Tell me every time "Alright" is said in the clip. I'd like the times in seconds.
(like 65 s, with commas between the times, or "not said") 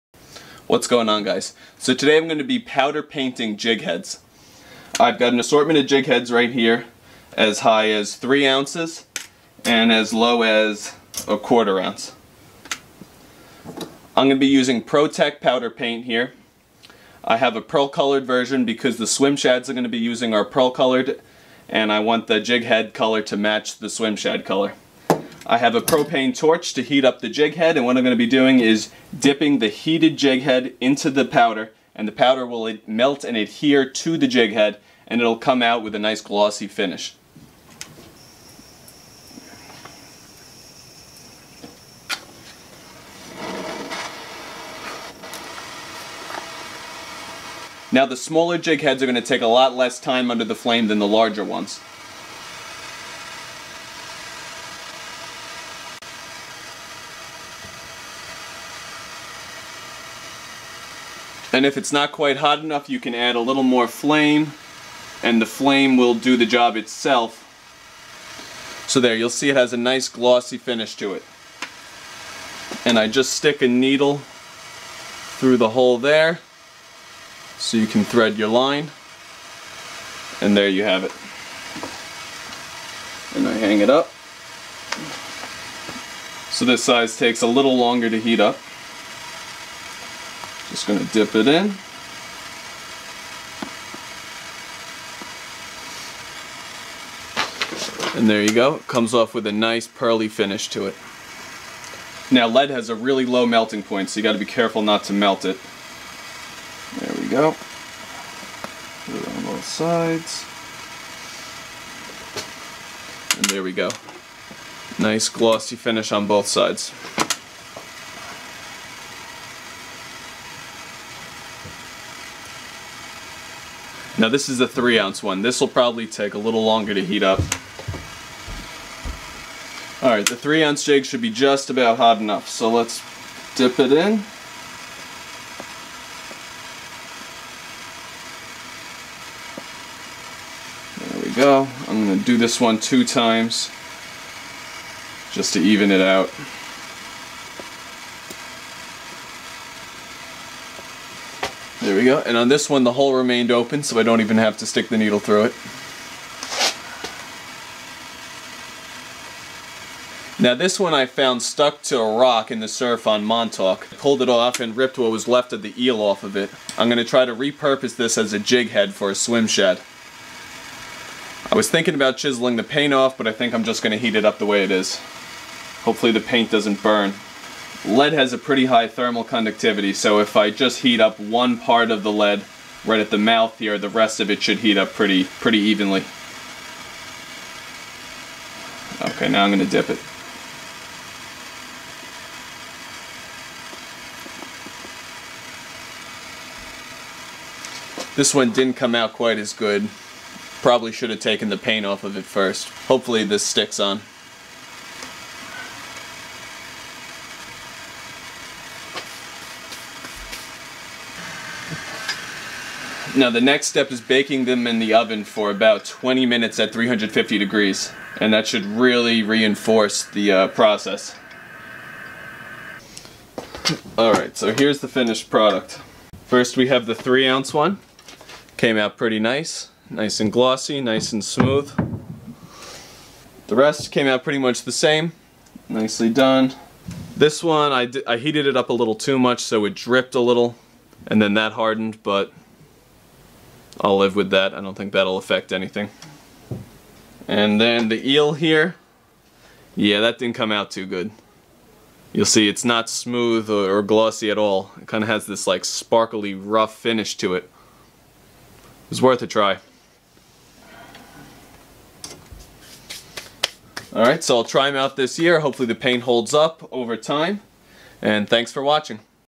223 s, 263 s.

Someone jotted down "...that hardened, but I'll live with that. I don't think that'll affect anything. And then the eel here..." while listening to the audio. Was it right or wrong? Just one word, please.
right.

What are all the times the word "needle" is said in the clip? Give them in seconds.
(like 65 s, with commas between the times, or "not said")
73 s, 154 s.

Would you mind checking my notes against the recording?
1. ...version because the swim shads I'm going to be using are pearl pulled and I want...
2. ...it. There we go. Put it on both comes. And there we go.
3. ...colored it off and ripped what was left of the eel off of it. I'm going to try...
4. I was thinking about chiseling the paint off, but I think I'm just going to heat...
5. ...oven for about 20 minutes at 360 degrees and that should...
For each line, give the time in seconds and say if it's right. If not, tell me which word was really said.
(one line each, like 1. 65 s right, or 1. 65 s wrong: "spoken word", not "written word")
1. 18 s wrong: "colored", not "pulled"
2. 105 s wrong: "sides", not "comes"
3. 163 s wrong: "pulled", not "colored"
4. 171 s right
5. 214 s wrong: "350", not "360".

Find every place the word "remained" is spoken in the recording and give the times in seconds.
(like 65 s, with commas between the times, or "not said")
153 s.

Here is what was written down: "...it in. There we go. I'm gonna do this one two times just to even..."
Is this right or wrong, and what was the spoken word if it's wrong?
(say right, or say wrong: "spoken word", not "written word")
right.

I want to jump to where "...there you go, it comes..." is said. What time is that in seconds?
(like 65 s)
98 s.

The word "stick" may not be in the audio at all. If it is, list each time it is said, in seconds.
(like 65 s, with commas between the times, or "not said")
73 s, 154 s, 203 s.